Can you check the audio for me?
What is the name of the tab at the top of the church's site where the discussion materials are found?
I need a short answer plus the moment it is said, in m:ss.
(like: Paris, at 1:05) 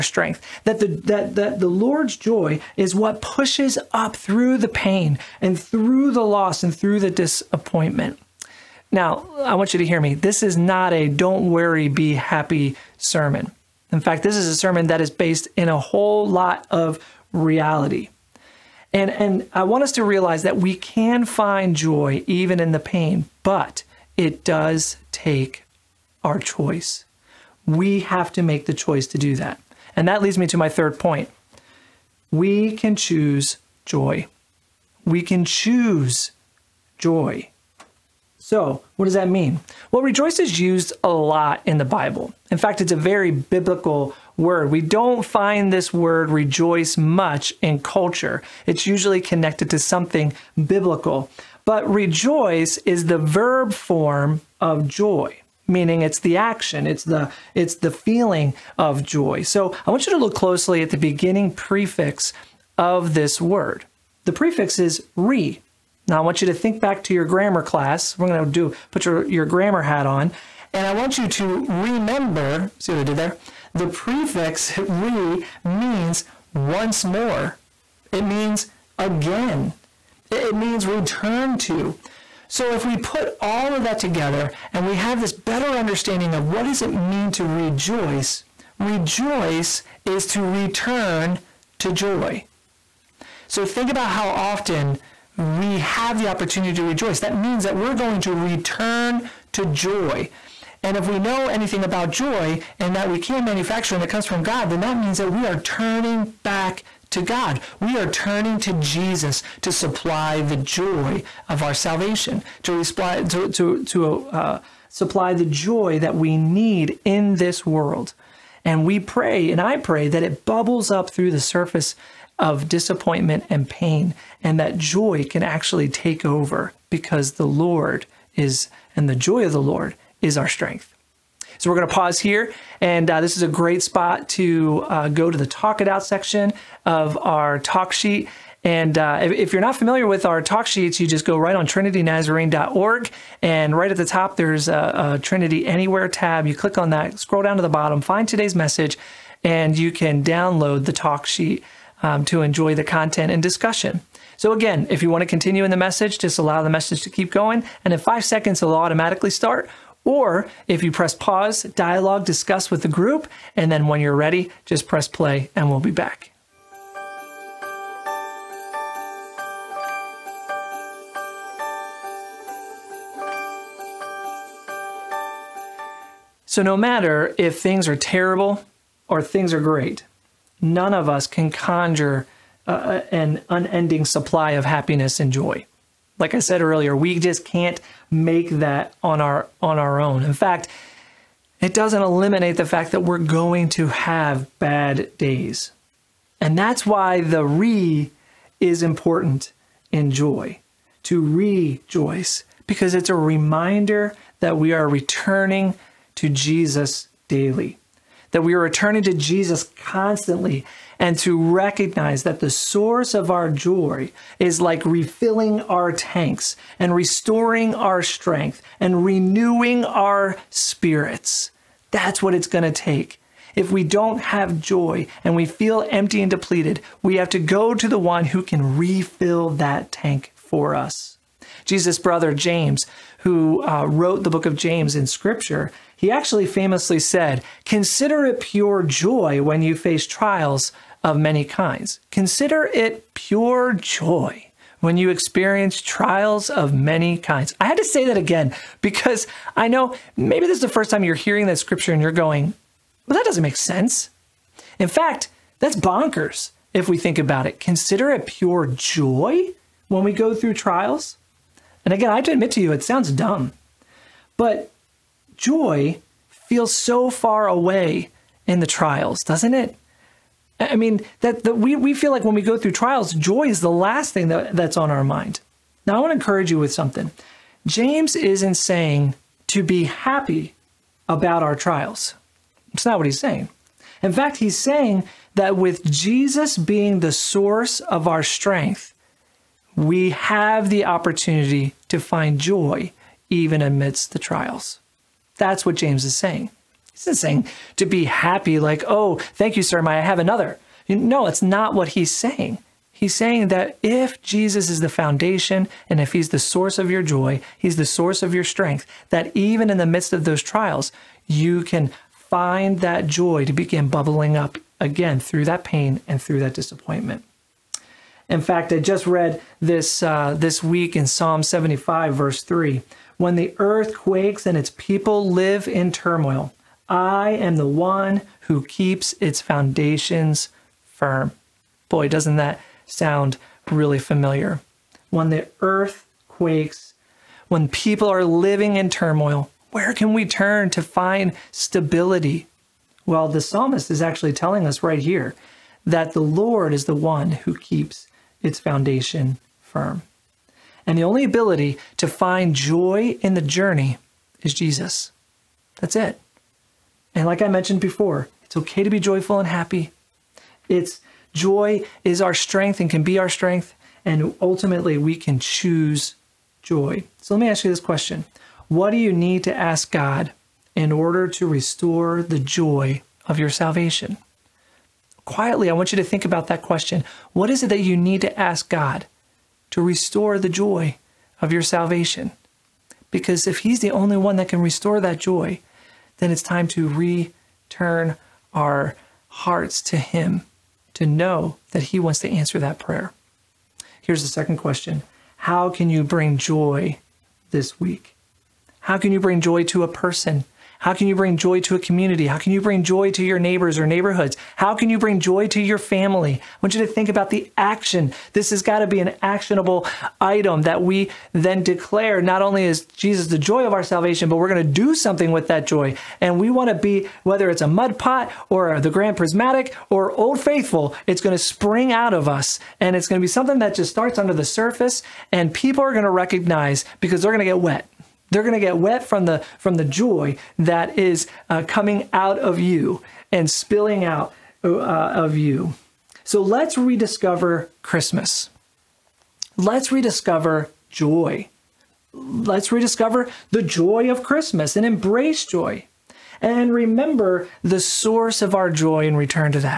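Trinity Anywhere, at 2:25.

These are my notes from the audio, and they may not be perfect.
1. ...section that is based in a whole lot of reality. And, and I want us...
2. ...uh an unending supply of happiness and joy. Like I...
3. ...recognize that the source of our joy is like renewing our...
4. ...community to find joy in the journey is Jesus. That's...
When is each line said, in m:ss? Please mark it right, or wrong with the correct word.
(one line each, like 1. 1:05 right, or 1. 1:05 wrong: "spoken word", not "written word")
1. 0:14 wrong: "sermon", not "section"
2. 3:02 right
3. 3:31 wrong: "refilling", not "renewing"
4. 5:51 wrong: "ability", not "community".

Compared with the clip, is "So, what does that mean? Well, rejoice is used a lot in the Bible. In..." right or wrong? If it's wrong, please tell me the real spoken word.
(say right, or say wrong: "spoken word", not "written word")
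right.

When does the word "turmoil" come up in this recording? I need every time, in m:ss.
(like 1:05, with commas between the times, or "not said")
5:25, 5:38.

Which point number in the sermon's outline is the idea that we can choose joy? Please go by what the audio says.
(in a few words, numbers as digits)
Third.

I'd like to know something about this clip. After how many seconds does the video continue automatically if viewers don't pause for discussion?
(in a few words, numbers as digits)
5.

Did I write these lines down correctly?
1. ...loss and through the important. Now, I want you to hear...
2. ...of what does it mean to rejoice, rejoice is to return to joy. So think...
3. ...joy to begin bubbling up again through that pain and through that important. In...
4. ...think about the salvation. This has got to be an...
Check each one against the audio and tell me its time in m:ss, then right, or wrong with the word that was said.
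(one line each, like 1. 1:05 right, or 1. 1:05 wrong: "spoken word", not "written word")
1. 0:06 wrong: "disappointment", not "important"
2. 1:26 right
3. 5:13 wrong: "disappointment", not "important"
4. 6:46 wrong: "action", not "salvation".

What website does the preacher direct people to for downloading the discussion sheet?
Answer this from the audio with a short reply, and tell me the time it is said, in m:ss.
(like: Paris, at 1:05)
trinitynazarene.org, at 2:21.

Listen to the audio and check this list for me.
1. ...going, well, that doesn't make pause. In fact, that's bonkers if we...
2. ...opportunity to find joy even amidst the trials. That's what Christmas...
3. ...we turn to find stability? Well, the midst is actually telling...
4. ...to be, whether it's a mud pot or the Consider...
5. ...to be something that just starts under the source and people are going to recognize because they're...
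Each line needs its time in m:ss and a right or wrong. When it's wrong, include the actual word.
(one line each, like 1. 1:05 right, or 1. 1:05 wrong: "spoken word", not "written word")
1. 4:12 wrong: "sense", not "pause"
2. 4:50 wrong: "James", not "Christmas"
3. 5:40 wrong: "psalmist", not "midst"
4. 6:56 wrong: "Grand", not "Consider"
5. 7:03 wrong: "surface", not "source".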